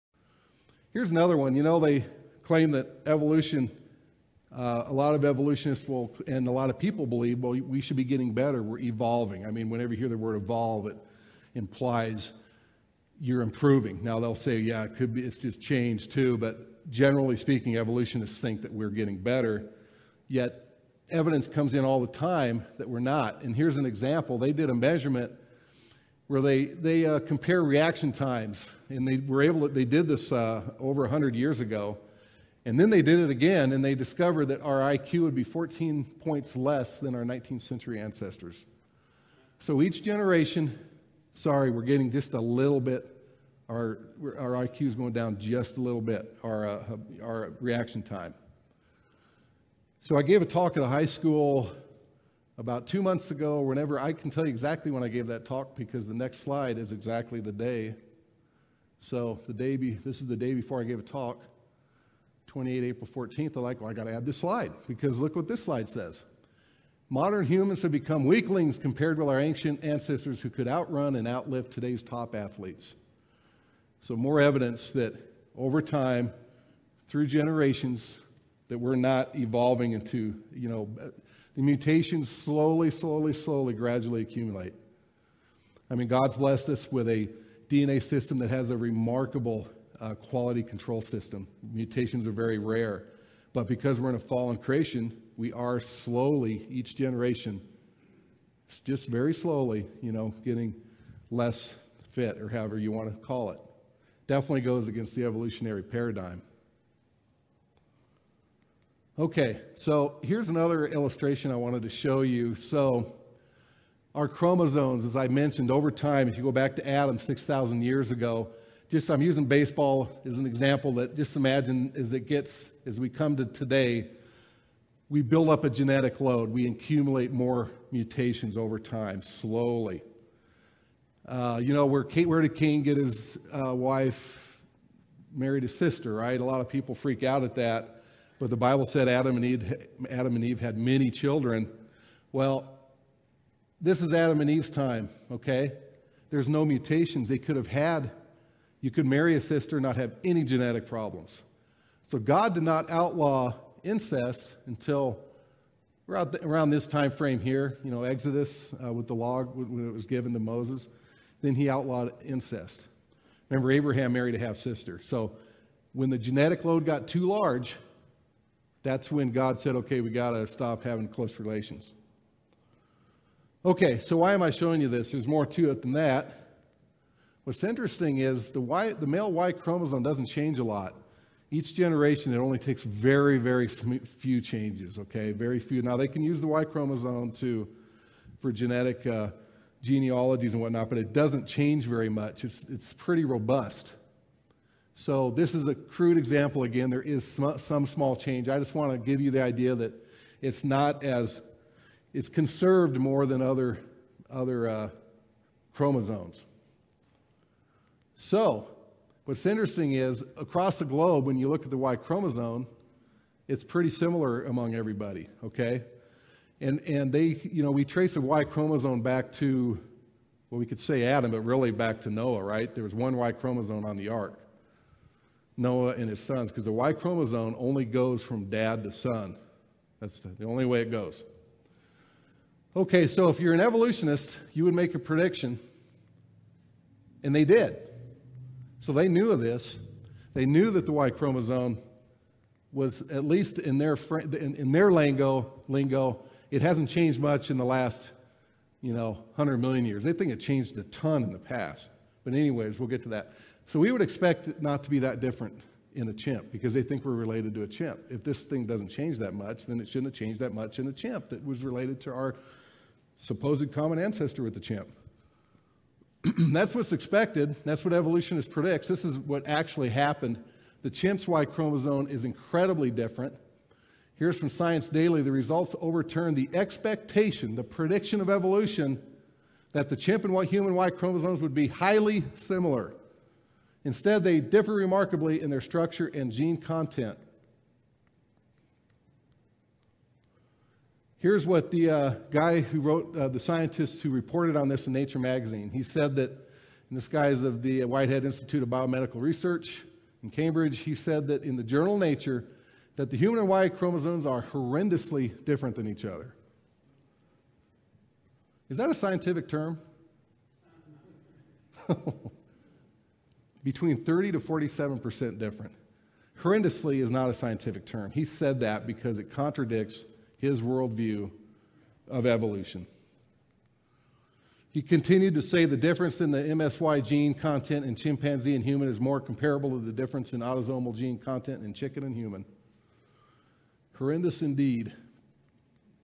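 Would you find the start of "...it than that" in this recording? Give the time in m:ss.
2:55.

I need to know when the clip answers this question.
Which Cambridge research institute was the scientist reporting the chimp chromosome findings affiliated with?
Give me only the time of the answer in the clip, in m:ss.
4:57.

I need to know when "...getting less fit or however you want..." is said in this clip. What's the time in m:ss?
1:40.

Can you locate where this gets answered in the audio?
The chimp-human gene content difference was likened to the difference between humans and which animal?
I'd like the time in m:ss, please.
5:31.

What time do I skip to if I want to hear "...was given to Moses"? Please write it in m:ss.
2:39.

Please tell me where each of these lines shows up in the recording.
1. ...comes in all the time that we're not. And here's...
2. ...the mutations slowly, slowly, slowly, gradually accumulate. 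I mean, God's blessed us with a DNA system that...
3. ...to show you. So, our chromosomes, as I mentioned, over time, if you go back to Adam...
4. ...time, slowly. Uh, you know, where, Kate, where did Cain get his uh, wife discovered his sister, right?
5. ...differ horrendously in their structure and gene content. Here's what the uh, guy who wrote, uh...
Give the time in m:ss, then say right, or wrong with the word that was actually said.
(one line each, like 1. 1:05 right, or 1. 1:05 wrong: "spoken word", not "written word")
1. 0:21 right
2. 1:21 right
3. 1:51 right
4. 2:08 wrong: "married", not "discovered"
5. 4:44 wrong: "remarkably", not "horrendously".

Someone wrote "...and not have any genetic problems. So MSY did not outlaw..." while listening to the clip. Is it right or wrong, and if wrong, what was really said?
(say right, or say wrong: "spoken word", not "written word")
wrong: "God", not "MSY".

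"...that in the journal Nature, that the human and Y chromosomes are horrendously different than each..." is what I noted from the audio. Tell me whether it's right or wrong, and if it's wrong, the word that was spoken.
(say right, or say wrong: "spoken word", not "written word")
right.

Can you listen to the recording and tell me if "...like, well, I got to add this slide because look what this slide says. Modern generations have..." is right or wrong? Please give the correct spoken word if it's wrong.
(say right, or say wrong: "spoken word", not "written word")
wrong: "humans", not "generations".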